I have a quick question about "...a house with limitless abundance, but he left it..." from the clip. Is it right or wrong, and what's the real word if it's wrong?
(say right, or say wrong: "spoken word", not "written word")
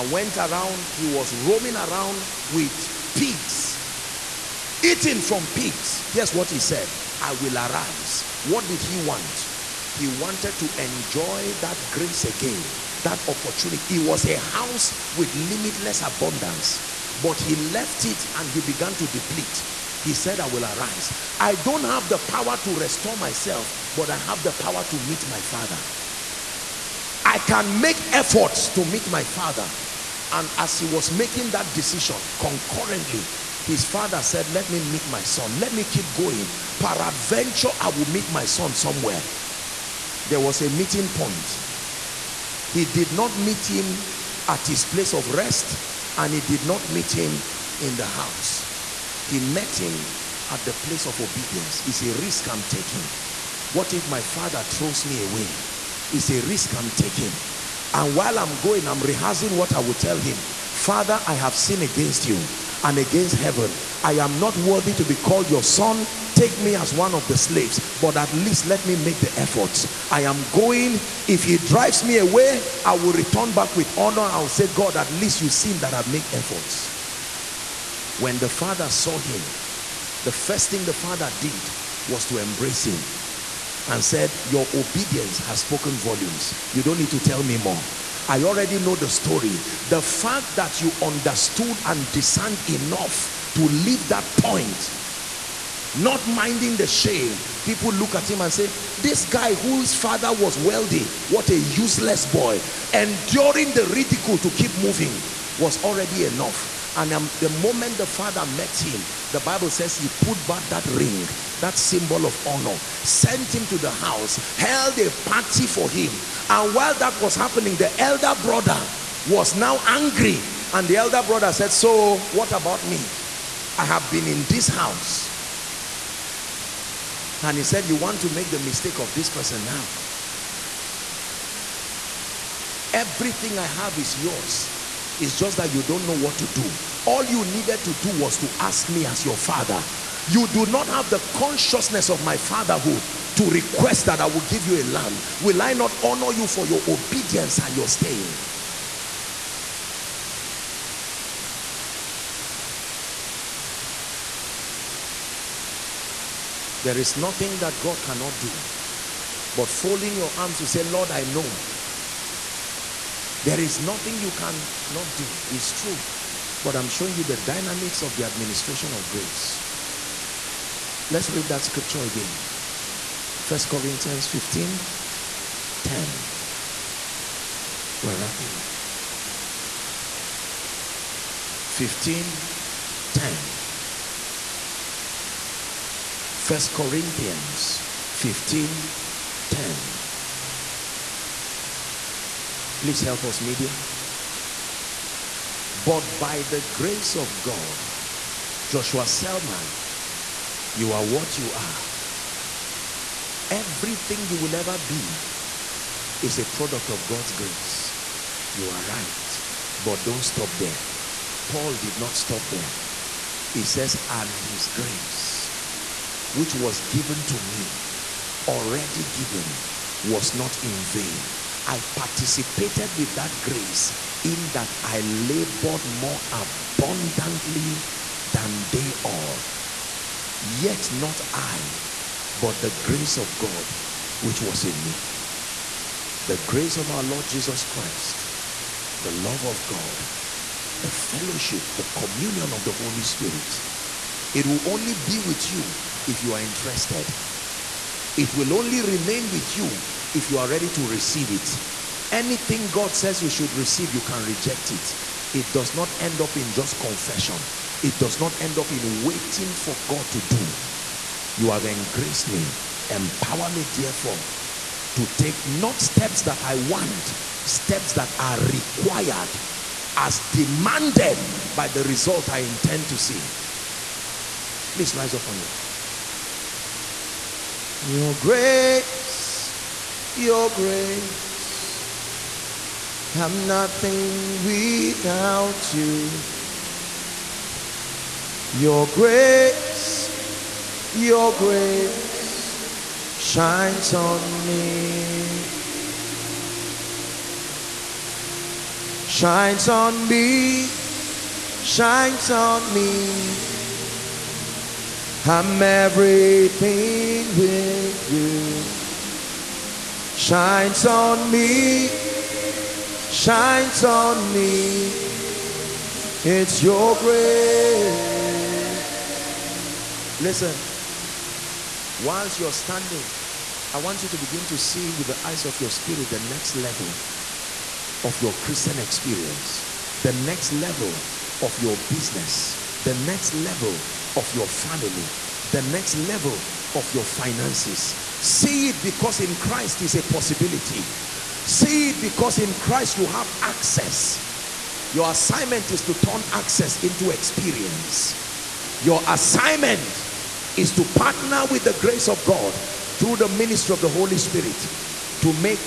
right.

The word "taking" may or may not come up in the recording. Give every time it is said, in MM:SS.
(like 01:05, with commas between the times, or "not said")
00:52, 00:56.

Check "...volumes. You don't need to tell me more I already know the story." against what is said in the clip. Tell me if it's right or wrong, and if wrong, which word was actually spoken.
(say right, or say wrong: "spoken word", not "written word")
right.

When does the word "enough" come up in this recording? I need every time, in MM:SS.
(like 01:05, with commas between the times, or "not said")
01:32, 01:46.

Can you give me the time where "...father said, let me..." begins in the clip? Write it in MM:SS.
00:33.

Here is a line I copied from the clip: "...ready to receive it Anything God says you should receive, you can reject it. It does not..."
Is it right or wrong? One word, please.
right.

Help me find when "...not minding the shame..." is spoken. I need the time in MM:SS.
01:35.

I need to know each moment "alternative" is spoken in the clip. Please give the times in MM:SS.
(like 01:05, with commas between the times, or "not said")
not said.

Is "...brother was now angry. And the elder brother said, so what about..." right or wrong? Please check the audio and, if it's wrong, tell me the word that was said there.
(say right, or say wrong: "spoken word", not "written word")
right.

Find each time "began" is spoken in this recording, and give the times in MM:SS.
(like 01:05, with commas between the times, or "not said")
00:18.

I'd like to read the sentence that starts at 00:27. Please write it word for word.
I can make efforts to meet my father.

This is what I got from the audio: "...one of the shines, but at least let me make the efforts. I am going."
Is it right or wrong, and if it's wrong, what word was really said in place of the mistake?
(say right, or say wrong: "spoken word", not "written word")
wrong: "slaves", not "shines".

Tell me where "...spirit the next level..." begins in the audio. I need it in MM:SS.
05:25.